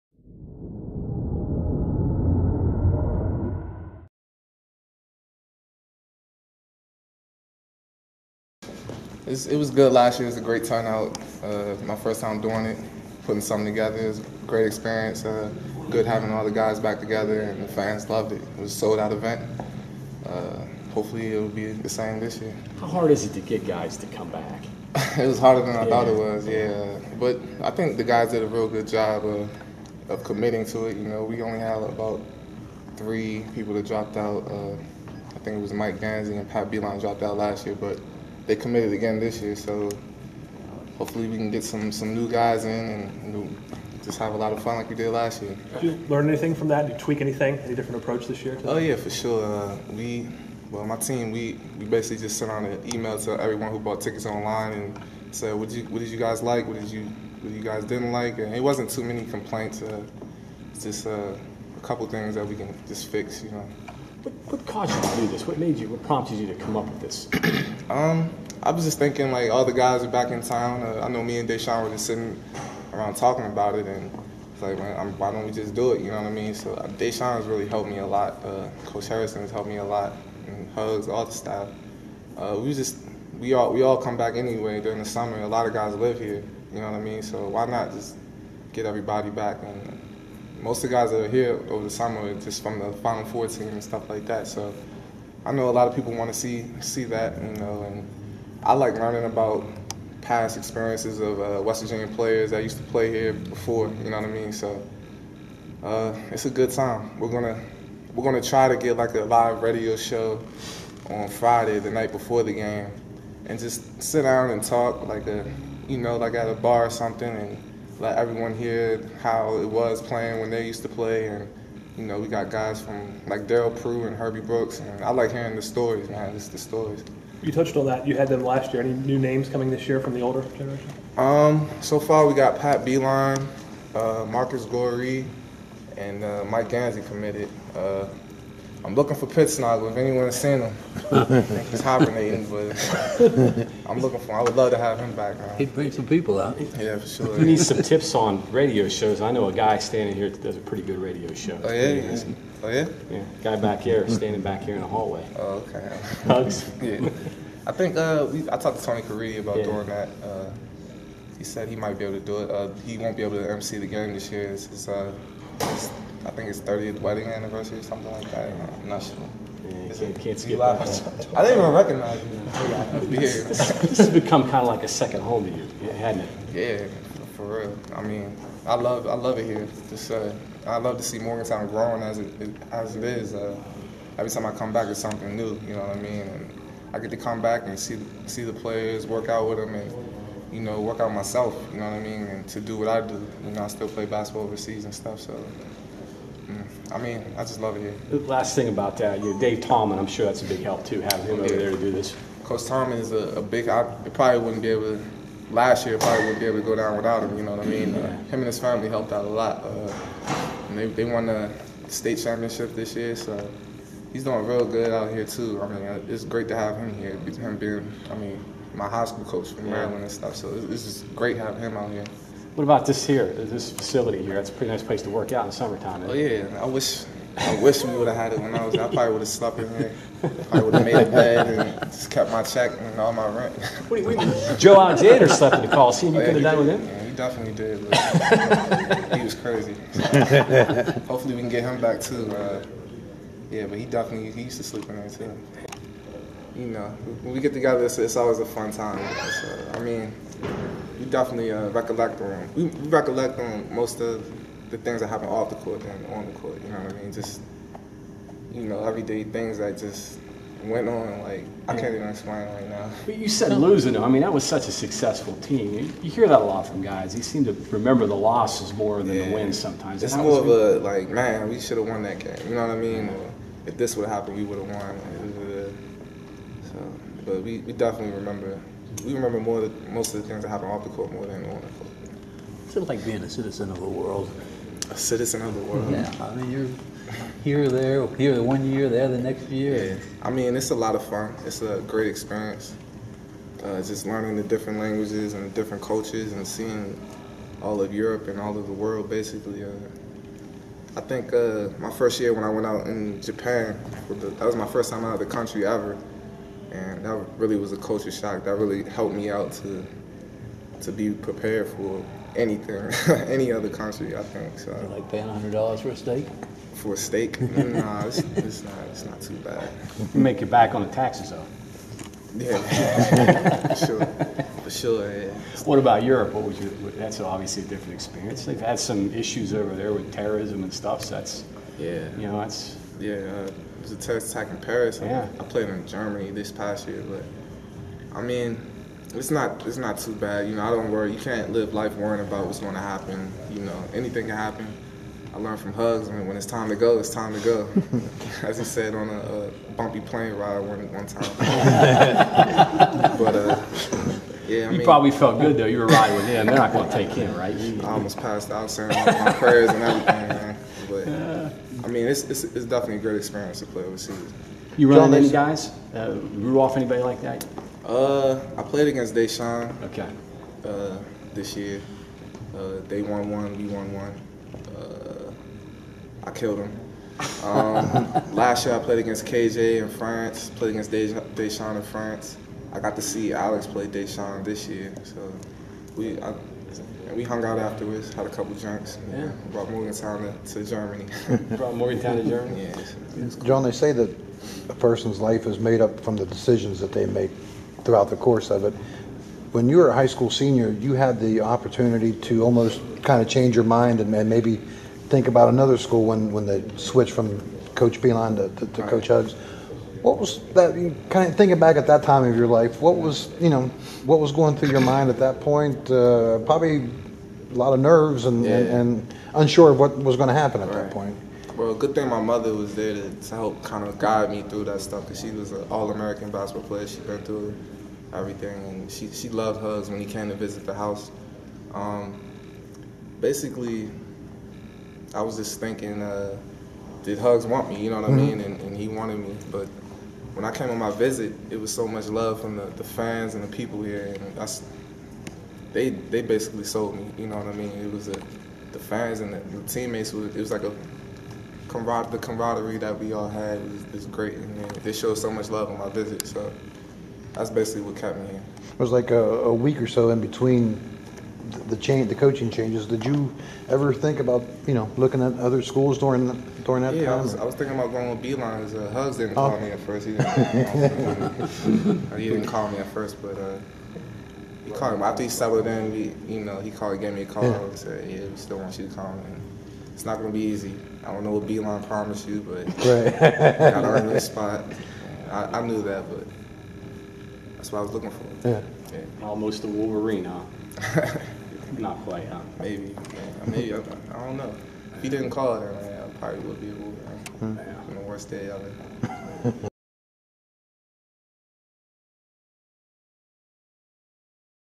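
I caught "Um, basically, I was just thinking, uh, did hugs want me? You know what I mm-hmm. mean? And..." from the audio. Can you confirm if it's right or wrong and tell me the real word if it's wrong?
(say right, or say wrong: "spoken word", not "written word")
right.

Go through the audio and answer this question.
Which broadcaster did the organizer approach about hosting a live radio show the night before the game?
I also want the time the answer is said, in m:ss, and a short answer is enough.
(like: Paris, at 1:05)
Tony Caridi, at 2:38.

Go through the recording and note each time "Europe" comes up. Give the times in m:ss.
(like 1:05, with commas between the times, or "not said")
4:57, 5:26.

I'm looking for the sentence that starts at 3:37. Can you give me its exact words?
Him being, I mean, my high school coach from Maryland and stuff.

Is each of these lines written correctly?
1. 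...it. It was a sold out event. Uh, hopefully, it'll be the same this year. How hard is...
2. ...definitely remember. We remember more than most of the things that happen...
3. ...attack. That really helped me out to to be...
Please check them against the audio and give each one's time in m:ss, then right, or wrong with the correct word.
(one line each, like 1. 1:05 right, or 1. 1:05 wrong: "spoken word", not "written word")
1. 0:18 right
2. 4:37 right
3. 5:08 wrong: "shock", not "attack".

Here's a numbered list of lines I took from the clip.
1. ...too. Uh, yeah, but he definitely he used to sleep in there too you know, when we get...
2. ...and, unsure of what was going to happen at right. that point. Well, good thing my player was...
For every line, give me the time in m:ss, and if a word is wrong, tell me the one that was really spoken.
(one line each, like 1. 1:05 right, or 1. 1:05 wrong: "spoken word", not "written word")
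1. 4:02 right
2. 6:58 wrong: "mother", not "player".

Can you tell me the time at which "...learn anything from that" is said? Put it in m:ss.
0:46.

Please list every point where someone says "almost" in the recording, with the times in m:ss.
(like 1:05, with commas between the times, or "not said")
5:57, 6:42, 8:09.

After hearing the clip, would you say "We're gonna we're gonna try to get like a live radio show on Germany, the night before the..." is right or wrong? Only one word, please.
wrong.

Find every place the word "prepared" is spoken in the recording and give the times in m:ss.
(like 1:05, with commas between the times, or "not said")
5:11.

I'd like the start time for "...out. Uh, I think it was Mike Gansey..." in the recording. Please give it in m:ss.
0:34.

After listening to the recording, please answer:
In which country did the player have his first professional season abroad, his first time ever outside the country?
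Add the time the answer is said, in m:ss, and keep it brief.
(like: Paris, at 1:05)
Japan, at 5:03.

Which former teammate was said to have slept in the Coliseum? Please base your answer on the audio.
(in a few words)
Joe Alexander.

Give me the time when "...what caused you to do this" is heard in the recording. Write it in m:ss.
1:04.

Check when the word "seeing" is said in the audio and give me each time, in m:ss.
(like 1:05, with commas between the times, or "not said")
4:56.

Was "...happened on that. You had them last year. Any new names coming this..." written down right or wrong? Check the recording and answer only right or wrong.
wrong.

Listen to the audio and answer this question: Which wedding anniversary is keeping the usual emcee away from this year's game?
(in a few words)
30th.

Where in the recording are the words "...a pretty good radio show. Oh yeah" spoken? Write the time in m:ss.
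2:30.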